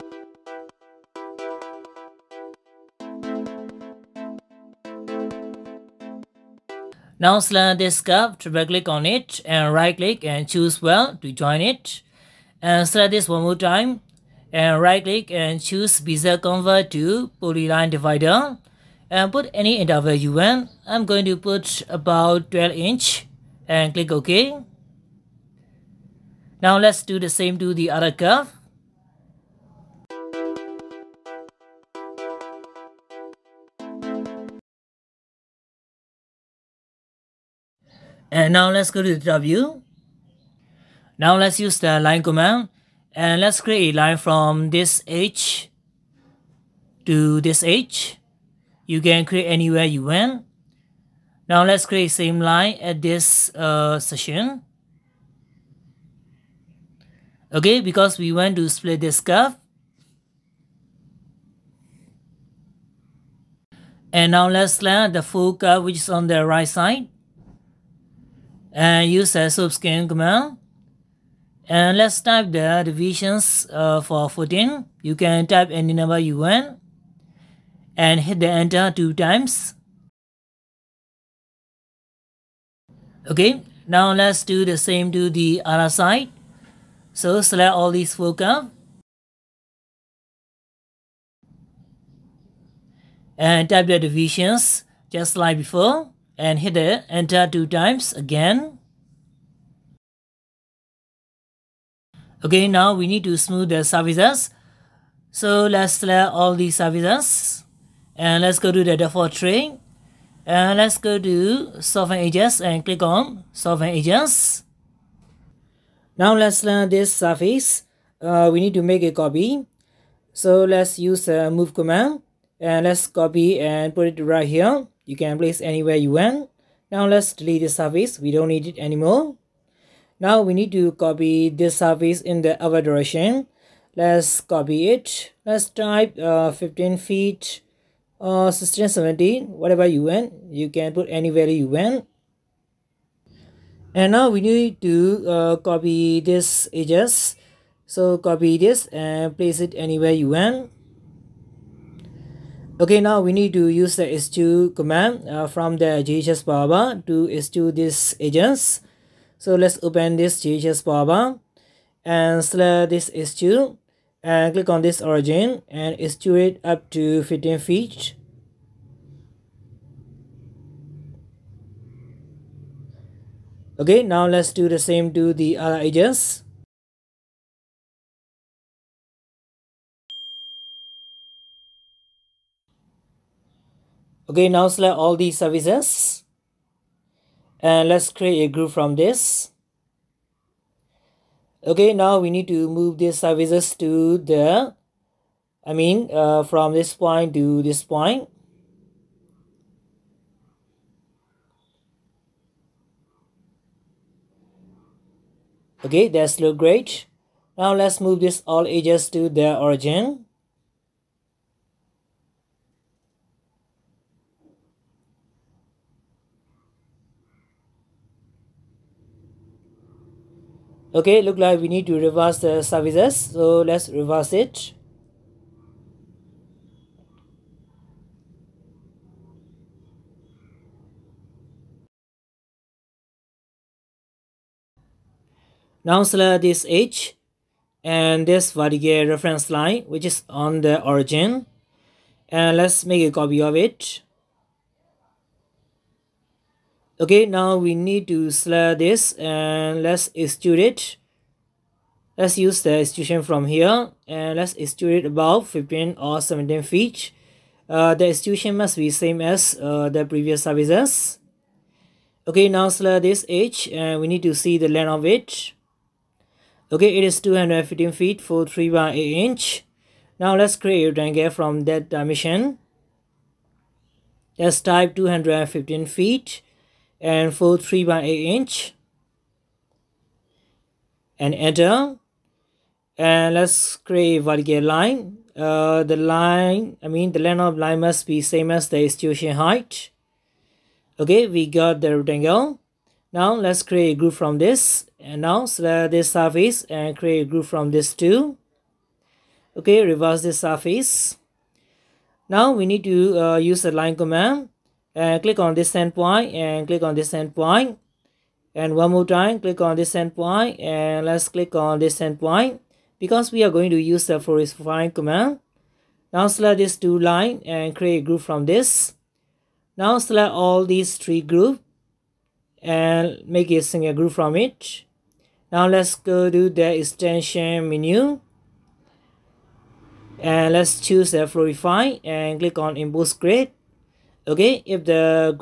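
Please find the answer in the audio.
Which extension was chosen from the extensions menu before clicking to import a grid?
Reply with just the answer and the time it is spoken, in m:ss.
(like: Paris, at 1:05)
Flowify, at 5:31.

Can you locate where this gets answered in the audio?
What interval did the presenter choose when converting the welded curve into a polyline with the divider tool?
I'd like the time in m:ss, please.
0:22.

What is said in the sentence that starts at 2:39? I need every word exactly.
So let's open this JHS Power and select this s2 and click on this origin and s2 it up to 15 feet.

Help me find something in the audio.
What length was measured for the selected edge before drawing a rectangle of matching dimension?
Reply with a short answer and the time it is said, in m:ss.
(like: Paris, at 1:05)
215 feet 3/8 inch, at 4:27.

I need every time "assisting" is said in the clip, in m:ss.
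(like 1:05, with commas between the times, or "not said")
not said.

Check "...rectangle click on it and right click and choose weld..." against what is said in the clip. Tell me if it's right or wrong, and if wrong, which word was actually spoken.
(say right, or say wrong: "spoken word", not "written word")
wrong: "triple", not "rectangle".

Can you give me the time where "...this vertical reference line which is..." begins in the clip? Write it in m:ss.
3:58.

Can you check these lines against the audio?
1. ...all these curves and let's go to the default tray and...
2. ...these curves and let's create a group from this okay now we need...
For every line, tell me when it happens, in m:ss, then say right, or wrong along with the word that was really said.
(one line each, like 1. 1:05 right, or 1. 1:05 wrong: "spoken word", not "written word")
1. 1:46 wrong: "surfaces", not "curves"
2. 3:05 wrong: "services", not "curves".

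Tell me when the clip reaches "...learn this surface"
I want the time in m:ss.
1:56.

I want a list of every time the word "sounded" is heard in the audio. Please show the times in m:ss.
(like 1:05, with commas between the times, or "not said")
not said.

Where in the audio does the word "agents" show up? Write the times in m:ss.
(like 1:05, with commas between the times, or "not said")
2:38, 2:55.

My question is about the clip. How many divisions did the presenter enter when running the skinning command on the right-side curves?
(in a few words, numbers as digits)
14.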